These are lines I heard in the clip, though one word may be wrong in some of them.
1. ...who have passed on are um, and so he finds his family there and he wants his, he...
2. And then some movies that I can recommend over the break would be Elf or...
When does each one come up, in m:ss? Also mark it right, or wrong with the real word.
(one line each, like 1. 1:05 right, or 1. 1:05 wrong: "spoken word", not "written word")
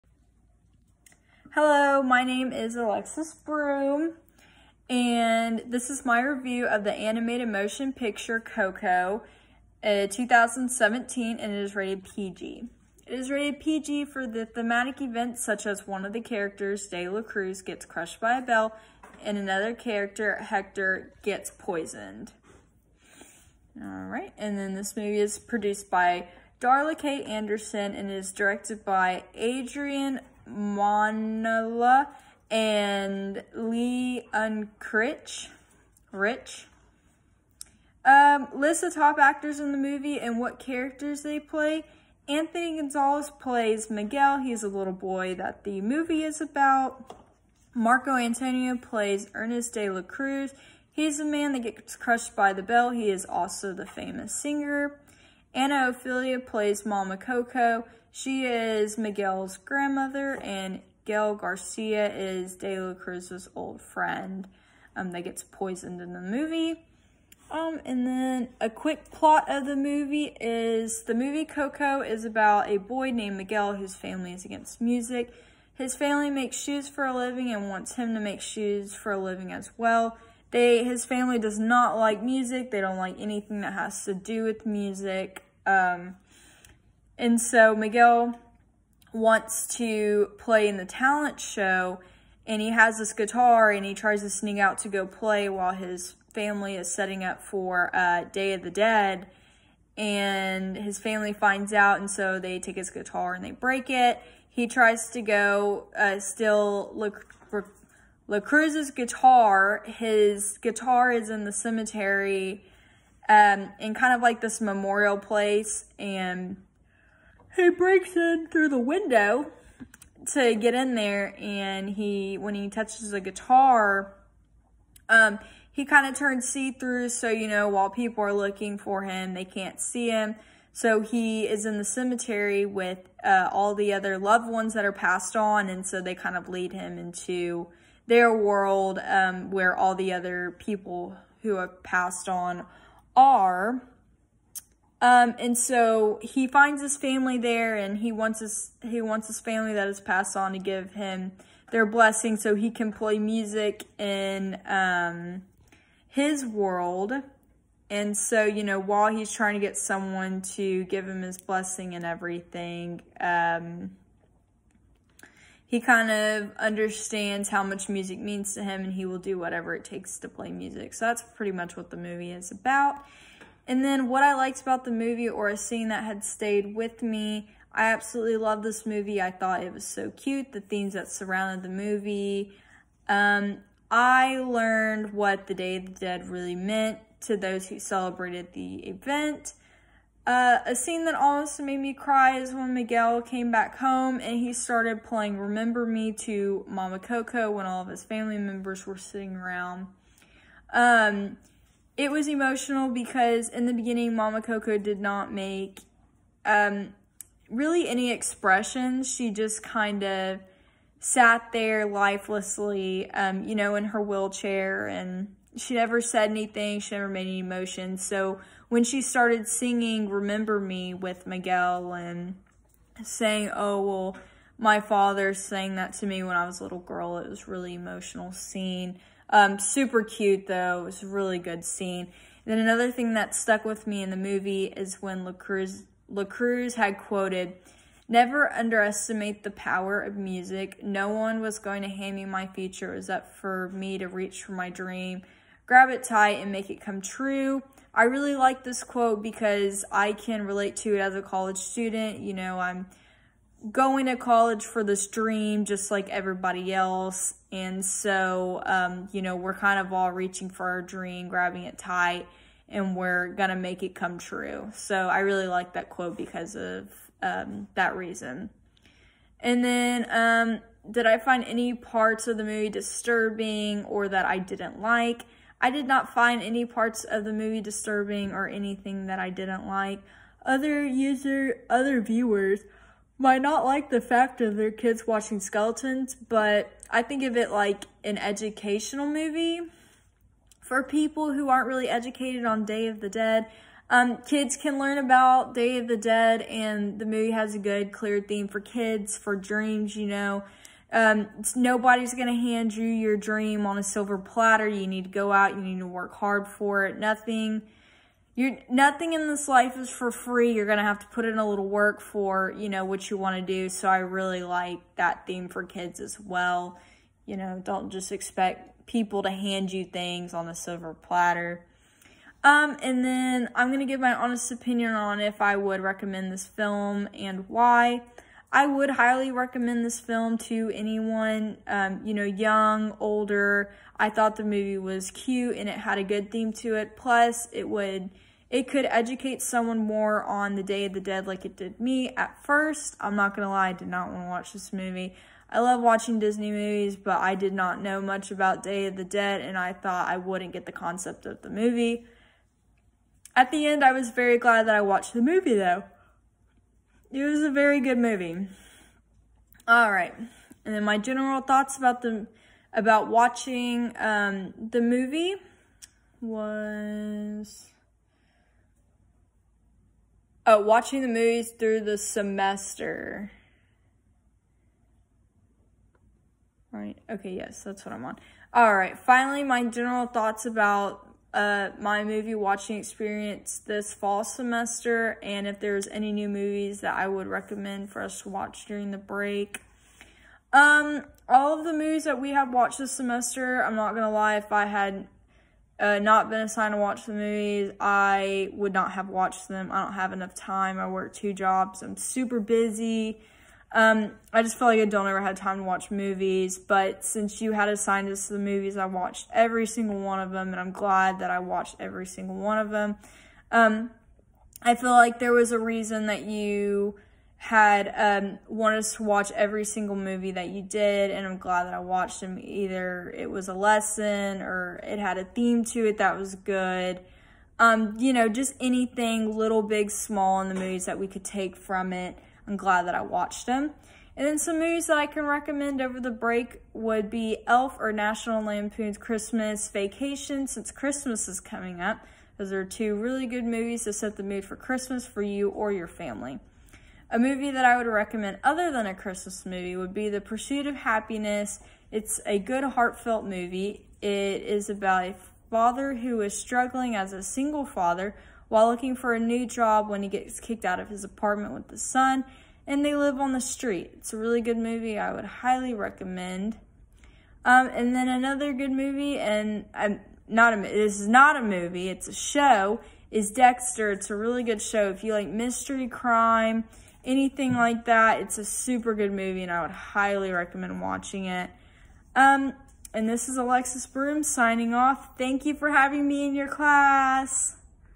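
1. 2:21 right
2. 7:14 right.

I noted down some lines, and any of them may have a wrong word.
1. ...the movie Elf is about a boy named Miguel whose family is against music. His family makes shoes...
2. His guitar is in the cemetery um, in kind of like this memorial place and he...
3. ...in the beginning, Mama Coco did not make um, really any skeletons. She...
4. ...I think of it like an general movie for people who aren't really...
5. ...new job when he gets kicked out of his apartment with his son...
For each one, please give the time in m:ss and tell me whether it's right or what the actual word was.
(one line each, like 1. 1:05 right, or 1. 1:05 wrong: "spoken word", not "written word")
1. 1:11 wrong: "Coco", not "Elf"
2. 1:49 right
3. 3:23 wrong: "expressions", not "skeletons"
4. 4:46 wrong: "educational", not "general"
5. 7:39 right.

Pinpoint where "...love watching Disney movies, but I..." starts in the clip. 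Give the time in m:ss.
5:45.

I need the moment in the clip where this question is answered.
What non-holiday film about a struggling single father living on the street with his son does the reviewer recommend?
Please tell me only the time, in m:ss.
7:30.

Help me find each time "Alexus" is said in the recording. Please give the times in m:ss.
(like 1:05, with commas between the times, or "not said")
0:02, 8:03.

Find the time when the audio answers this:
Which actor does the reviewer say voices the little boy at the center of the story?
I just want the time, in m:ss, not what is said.
0:42.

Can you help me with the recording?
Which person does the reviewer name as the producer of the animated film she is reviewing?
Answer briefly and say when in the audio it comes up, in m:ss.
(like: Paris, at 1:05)
Darla Kate Anderson, at 0:26.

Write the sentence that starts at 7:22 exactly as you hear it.
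Those are two really good movies to set the mood for Christmas for you or your family.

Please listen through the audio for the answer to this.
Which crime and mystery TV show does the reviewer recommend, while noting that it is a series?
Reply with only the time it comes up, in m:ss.
7:53.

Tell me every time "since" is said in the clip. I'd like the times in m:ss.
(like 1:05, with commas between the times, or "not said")
6:47, 7:20.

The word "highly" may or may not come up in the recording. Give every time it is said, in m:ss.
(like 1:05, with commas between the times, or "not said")
5:28, 7:45, 7:59.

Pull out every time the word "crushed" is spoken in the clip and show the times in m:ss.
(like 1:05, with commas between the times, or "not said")
0:17, 0:51.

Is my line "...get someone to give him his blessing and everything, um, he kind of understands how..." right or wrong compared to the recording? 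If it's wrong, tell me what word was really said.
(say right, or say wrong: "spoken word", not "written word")
right.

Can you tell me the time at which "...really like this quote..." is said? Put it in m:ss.
4:08.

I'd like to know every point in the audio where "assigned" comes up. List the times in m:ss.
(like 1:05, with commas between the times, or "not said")
6:36, 6:47.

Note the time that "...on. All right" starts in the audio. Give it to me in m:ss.
6:18.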